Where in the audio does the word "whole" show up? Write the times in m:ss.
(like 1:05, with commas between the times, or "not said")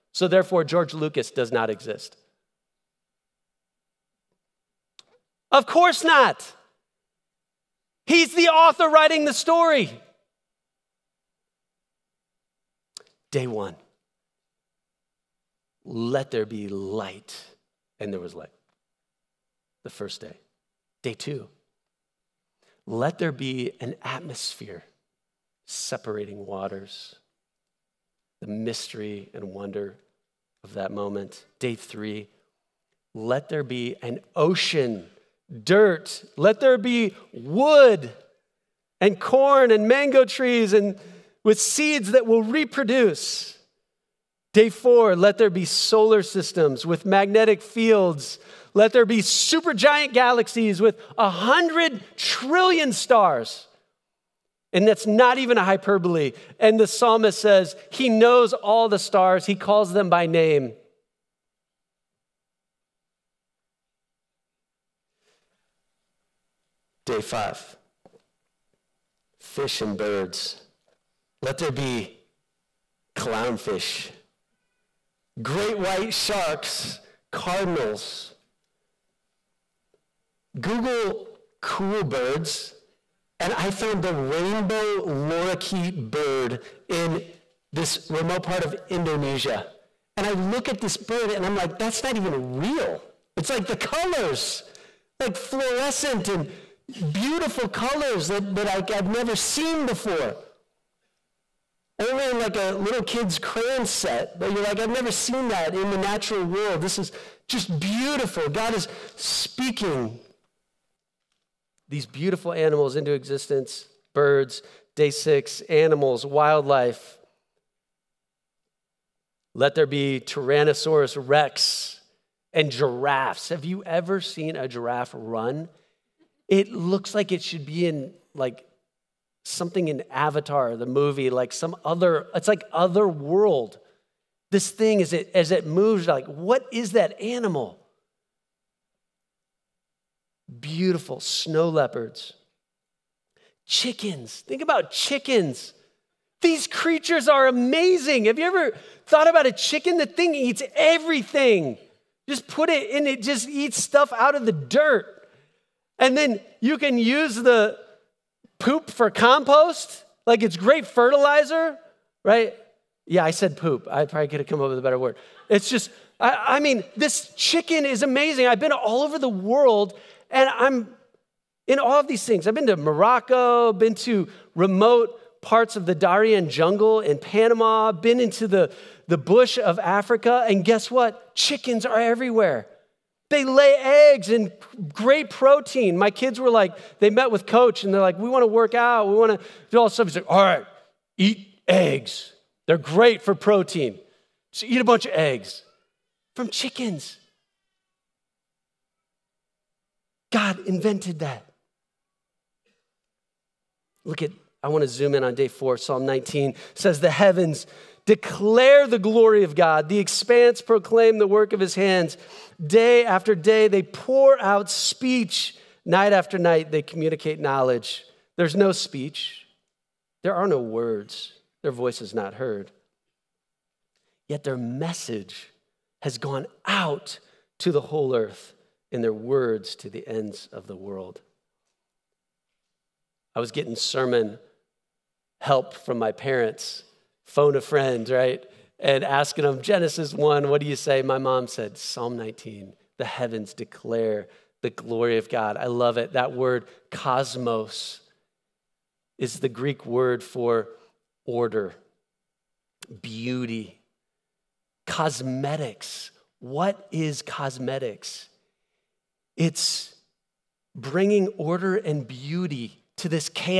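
3:47.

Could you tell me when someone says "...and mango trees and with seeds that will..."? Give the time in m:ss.
0:39.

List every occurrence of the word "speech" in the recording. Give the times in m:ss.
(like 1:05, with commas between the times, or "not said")
3:34, 3:38.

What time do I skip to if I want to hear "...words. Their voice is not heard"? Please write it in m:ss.
3:40.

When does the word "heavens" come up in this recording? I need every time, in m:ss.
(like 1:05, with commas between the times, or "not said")
3:27, 4:03.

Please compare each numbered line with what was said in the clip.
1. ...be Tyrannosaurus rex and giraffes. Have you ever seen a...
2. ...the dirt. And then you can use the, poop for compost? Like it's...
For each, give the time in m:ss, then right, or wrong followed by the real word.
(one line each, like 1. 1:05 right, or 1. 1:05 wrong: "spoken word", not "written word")
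1. 1:59 right
2. 2:34 right.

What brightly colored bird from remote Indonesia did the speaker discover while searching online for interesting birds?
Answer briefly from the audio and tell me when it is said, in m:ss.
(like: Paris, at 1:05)
Rainbow lorikeet, at 1:24.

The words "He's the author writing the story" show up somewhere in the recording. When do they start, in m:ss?
0:08.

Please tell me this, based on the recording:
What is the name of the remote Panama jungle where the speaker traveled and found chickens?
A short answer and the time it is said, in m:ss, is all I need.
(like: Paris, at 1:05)
Darien, at 2:55.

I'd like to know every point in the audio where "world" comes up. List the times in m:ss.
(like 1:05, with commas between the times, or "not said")
1:46, 2:13, 2:49, 3:50.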